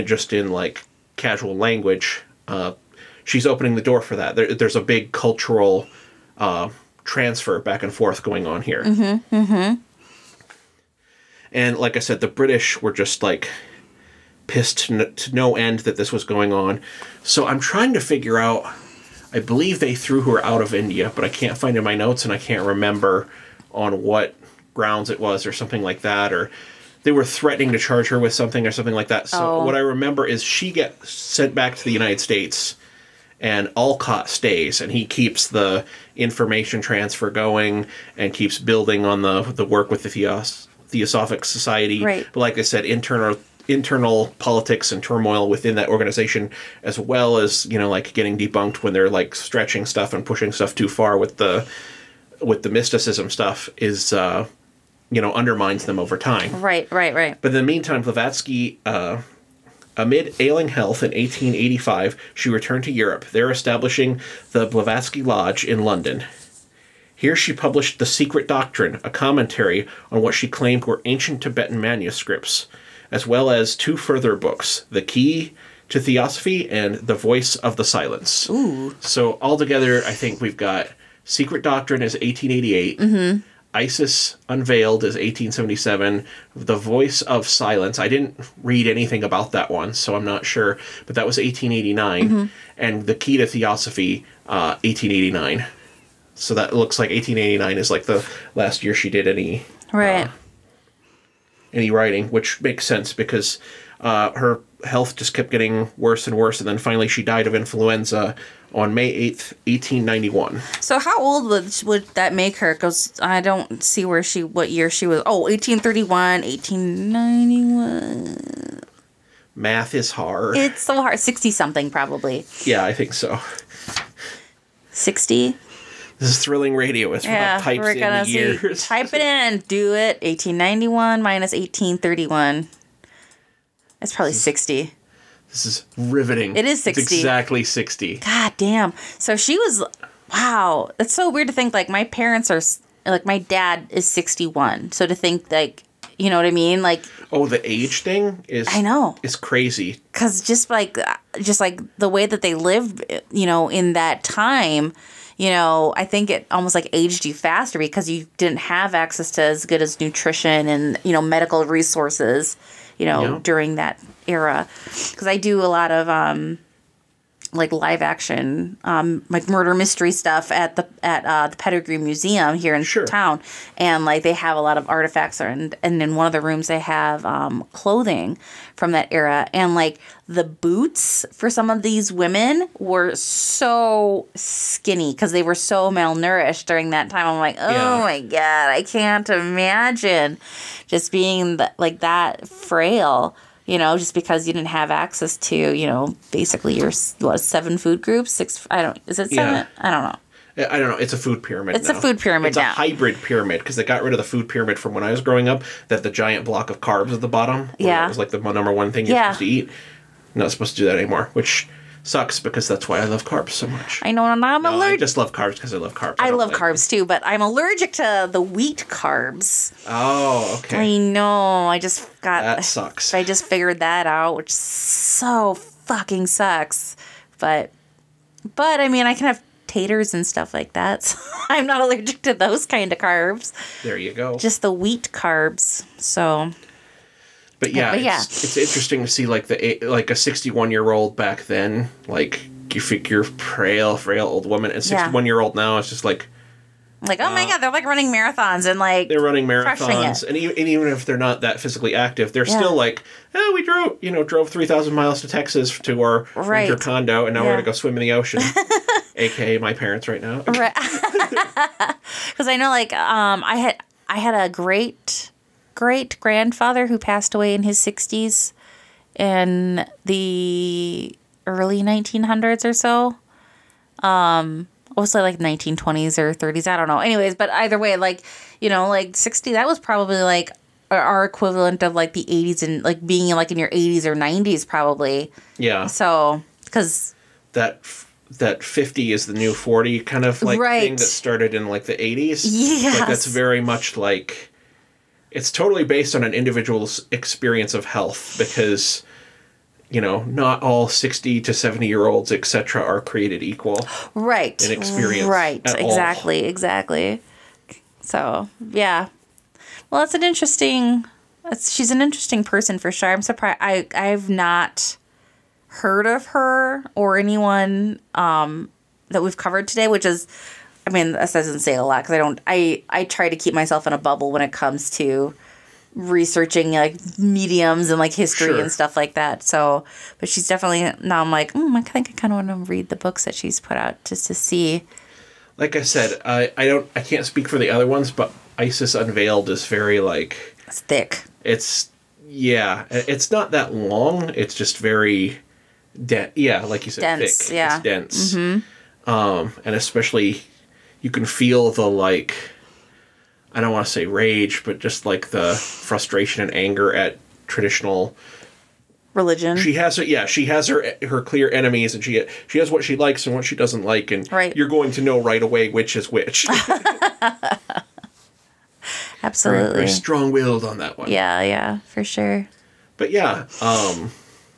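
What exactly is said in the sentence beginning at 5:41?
It's yeah, it's not that long.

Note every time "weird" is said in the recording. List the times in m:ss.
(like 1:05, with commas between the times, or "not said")
2:21.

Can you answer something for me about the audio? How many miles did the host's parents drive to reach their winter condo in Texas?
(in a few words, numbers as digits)
3000.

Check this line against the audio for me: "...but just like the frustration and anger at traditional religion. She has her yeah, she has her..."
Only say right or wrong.
right.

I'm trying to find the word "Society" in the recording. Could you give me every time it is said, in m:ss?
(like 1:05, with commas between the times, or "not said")
0:41.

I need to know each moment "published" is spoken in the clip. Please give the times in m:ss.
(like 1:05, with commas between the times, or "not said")
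1:07.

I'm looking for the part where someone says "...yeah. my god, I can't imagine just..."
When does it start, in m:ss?
3:07.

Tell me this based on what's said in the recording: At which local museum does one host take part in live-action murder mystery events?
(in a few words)
Pettigrew Museum.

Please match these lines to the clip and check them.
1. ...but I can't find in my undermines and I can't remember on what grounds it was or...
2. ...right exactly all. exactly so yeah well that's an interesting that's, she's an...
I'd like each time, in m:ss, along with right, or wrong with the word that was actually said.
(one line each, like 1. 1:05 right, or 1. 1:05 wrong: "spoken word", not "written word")
1. 0:21 wrong: "notes", not "undermines"
2. 5:05 right.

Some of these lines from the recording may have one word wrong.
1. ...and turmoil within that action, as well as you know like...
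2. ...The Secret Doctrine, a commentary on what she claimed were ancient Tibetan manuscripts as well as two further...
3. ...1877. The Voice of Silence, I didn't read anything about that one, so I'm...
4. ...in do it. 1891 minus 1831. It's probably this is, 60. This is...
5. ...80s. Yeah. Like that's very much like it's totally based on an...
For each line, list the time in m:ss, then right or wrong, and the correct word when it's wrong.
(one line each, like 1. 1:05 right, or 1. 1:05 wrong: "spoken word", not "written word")
1. 0:44 wrong: "organization", not "action"
2. 1:07 right
3. 1:25 right
4. 2:09 right
5. 4:51 right.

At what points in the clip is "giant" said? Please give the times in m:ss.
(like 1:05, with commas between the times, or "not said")
3:26.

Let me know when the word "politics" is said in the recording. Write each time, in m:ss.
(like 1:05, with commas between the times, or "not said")
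0:44.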